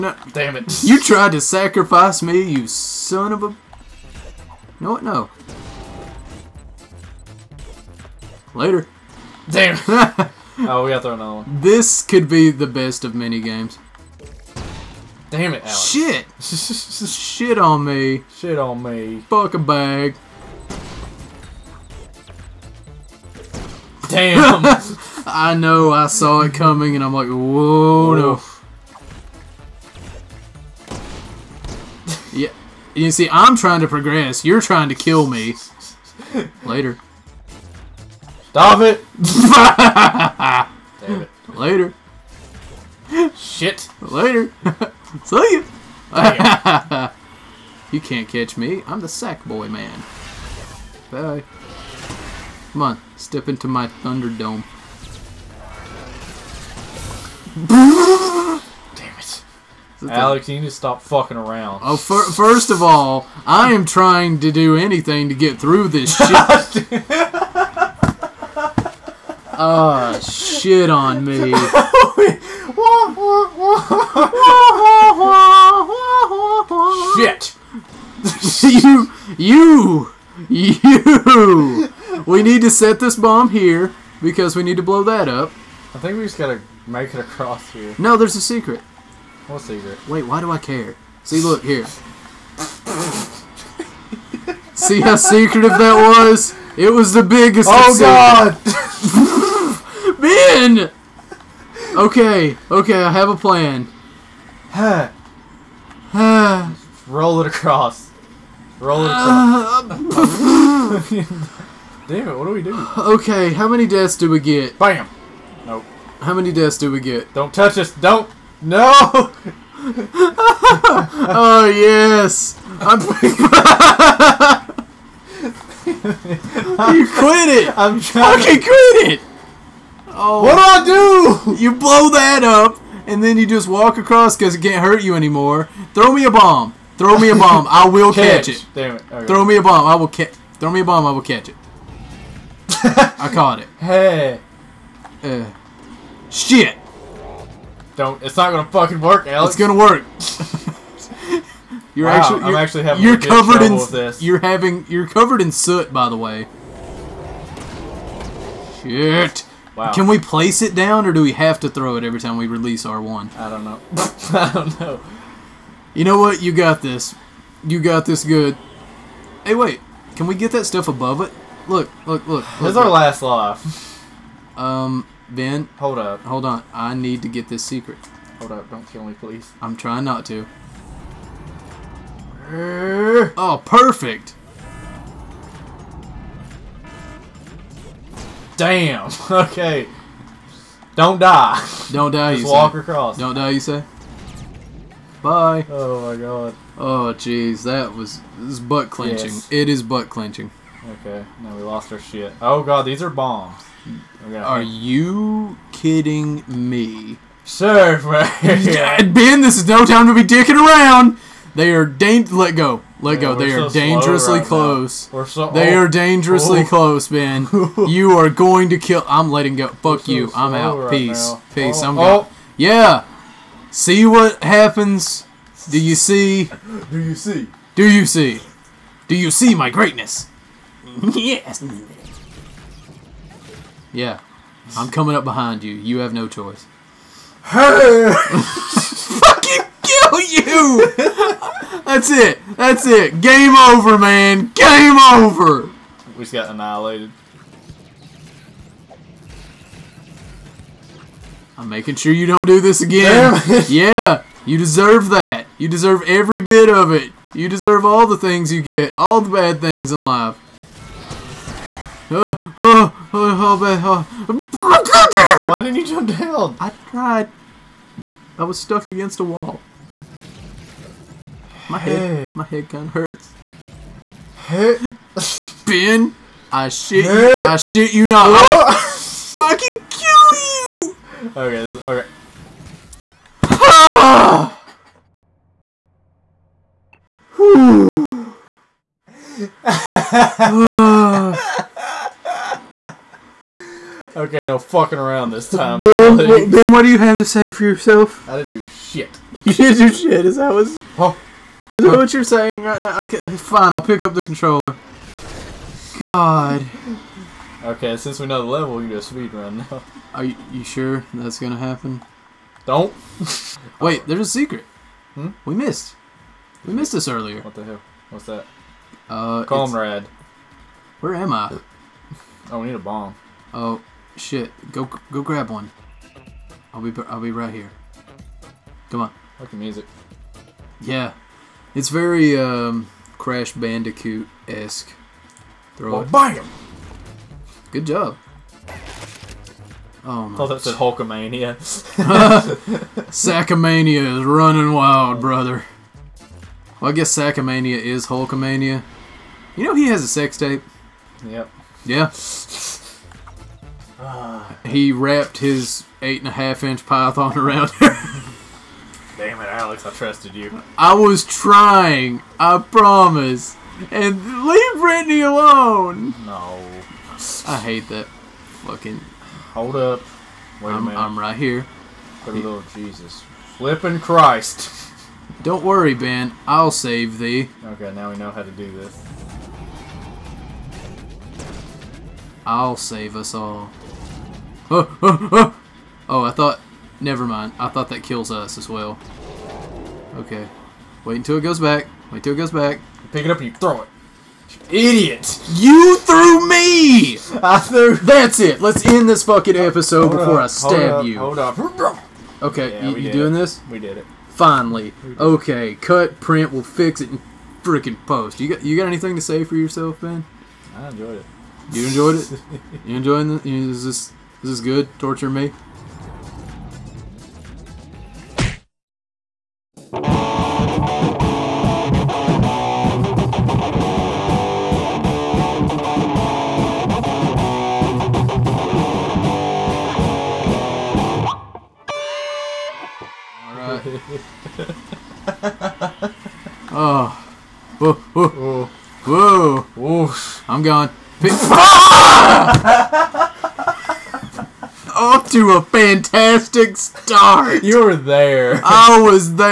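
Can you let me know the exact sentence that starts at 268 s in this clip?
I was stuck against a wall.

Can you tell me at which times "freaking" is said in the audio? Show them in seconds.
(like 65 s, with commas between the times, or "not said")
407 s.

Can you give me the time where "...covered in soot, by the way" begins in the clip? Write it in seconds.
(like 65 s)
155 s.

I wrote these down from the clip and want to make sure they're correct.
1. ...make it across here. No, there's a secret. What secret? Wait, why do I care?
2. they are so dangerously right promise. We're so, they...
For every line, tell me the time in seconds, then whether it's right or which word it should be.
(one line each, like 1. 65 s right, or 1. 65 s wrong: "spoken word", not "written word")
1. 86 s right
2. 213 s wrong: "close", not "promise".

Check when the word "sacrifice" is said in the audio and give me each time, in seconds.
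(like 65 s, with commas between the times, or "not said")
1 s.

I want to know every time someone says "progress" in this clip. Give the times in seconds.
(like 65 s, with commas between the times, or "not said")
33 s.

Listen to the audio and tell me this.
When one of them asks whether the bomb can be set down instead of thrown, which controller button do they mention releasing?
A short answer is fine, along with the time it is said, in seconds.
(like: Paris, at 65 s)
R1, at 162 s.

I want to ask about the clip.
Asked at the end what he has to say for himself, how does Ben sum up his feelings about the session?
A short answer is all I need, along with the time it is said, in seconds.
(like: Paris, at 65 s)
I enjoyed it, at 410 s.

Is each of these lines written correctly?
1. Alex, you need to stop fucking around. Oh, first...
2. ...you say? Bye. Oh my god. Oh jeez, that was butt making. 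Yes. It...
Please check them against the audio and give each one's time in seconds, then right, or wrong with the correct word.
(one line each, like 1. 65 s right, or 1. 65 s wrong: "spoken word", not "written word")
1. 60 s right
2. 193 s wrong: "clenching", not "making".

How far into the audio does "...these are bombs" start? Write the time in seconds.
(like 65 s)
202 s.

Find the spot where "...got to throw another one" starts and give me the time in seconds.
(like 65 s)
10 s.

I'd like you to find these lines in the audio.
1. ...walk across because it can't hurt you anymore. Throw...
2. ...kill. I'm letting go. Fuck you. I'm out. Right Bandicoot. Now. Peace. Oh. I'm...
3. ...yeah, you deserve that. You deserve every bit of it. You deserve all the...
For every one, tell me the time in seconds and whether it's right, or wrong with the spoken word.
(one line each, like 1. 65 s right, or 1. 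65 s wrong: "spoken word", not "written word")
1. 133 s right
2. 218 s wrong: "Peace", not "Bandicoot"
3. 253 s right.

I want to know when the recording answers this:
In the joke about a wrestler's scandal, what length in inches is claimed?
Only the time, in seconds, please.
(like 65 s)
356 s.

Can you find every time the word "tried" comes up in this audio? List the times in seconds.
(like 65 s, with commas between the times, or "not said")
1 s, 266 s.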